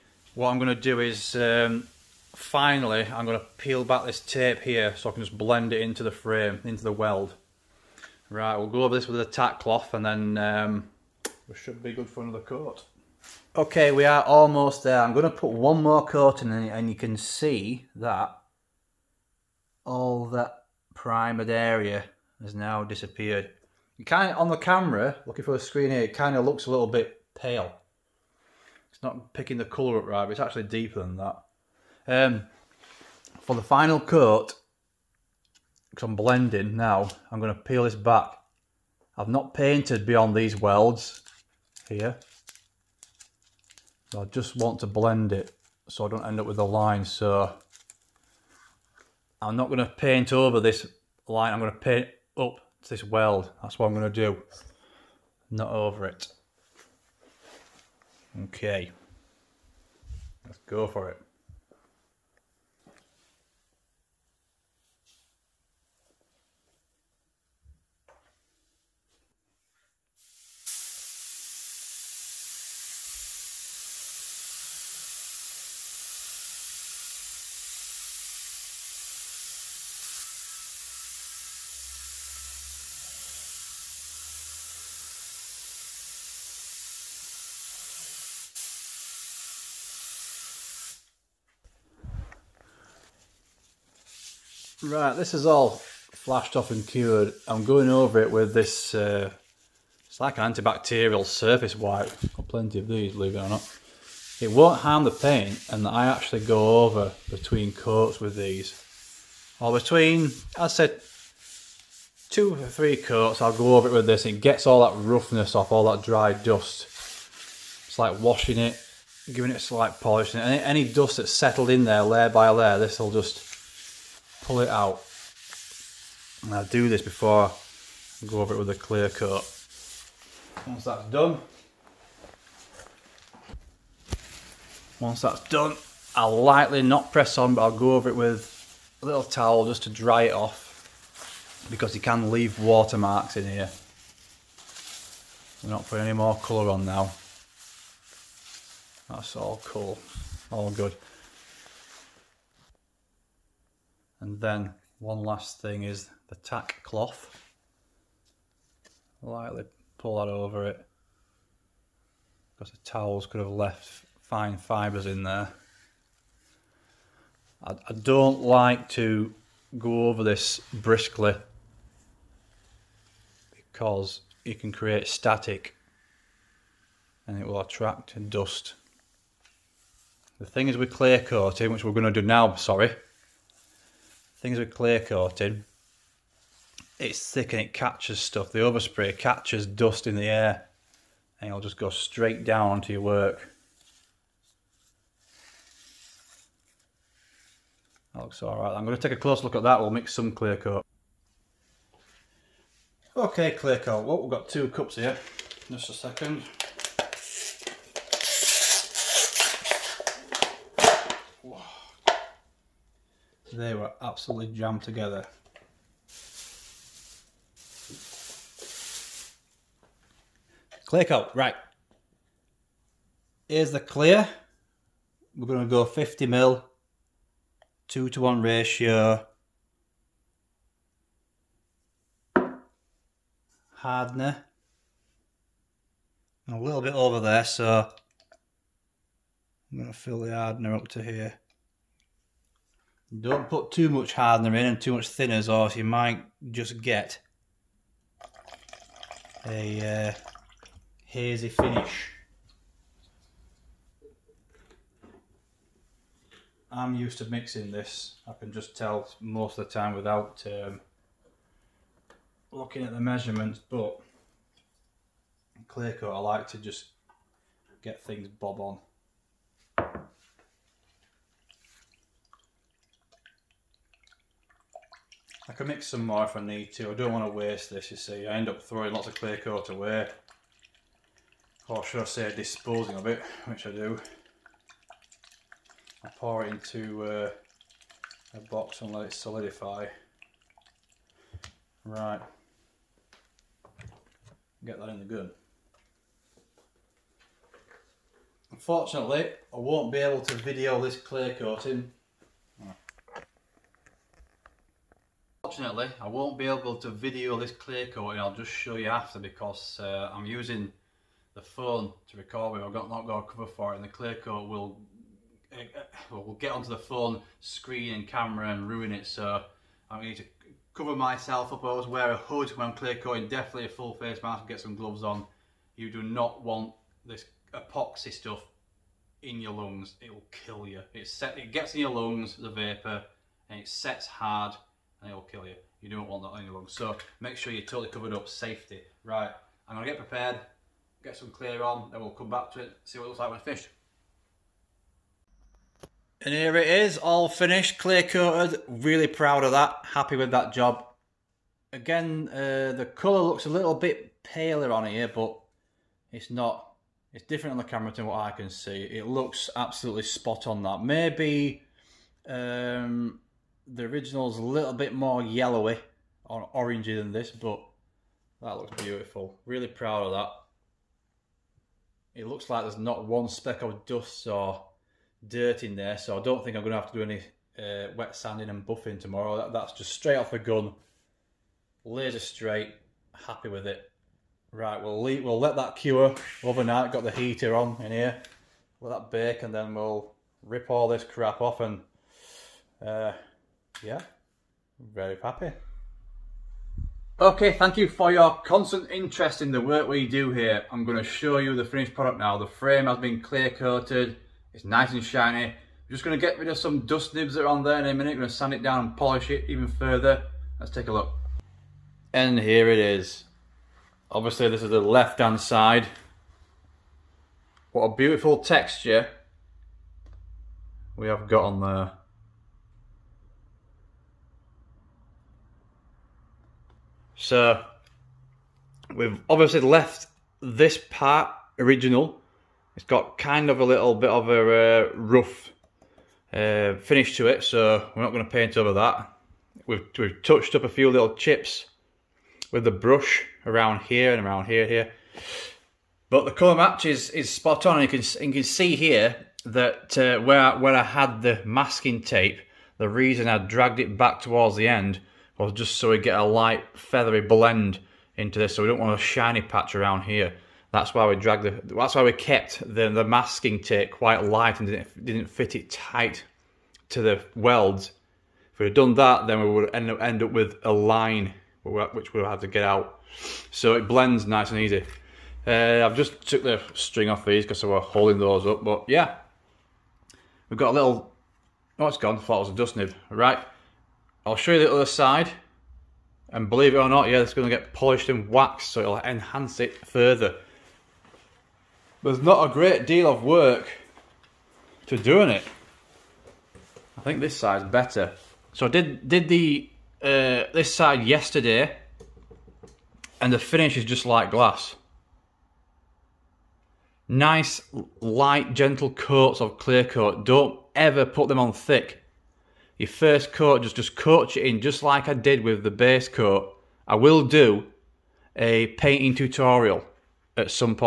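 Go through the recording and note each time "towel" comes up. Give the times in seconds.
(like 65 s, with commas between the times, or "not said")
139 s, 162 s.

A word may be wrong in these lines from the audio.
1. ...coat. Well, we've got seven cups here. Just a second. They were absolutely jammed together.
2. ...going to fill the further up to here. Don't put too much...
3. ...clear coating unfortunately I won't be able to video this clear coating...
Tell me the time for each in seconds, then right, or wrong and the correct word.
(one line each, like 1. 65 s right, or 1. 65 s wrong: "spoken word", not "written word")
1. 203 s wrong: "two", not "seven"
2. 239 s wrong: "hardener", not "further"
3. 300 s right.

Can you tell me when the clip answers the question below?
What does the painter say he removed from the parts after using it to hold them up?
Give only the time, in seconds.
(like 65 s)
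476 s.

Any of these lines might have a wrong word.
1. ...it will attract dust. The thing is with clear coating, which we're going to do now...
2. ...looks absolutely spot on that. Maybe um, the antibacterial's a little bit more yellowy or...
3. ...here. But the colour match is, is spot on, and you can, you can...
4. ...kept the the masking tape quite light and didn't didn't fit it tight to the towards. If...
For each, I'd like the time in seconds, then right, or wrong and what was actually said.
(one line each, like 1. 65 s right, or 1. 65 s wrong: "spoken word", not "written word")
1. 177 s right
2. 359 s wrong: "original", not "antibacterial"
3. 444 s right
4. 462 s wrong: "welds", not "towards".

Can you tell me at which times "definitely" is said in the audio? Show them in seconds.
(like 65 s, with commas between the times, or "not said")
323 s.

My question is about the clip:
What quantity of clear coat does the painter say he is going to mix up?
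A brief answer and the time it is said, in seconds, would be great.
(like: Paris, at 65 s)
50 ml, at 225 s.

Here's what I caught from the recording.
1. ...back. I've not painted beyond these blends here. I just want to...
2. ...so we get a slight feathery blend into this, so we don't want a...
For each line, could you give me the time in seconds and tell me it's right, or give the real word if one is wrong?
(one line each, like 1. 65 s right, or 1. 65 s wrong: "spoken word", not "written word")
1. 37 s wrong: "welds", not "blends"
2. 455 s wrong: "light", not "slight".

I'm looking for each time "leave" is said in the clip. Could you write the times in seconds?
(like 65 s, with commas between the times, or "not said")
142 s, 385 s.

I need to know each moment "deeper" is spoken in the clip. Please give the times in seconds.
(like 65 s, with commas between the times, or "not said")
30 s.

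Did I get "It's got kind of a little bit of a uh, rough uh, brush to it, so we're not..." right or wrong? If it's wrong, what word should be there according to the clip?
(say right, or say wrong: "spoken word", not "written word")
wrong: "finish", not "brush".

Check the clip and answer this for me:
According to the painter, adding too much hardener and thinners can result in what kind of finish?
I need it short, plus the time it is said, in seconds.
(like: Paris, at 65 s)
hazy, at 251 s.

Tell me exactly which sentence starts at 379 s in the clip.
That, that's just straight off the gun, laser straight, happy with it.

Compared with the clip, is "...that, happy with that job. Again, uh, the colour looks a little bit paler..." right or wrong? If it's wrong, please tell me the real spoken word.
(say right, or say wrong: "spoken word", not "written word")
right.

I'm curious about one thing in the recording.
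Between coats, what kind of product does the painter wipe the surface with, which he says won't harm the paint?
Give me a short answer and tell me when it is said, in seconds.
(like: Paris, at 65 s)
antibacterial surface wipe, at 100 s.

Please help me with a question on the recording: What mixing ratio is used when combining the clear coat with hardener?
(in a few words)
2 to 1.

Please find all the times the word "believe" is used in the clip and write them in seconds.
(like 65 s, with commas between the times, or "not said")
103 s, 486 s.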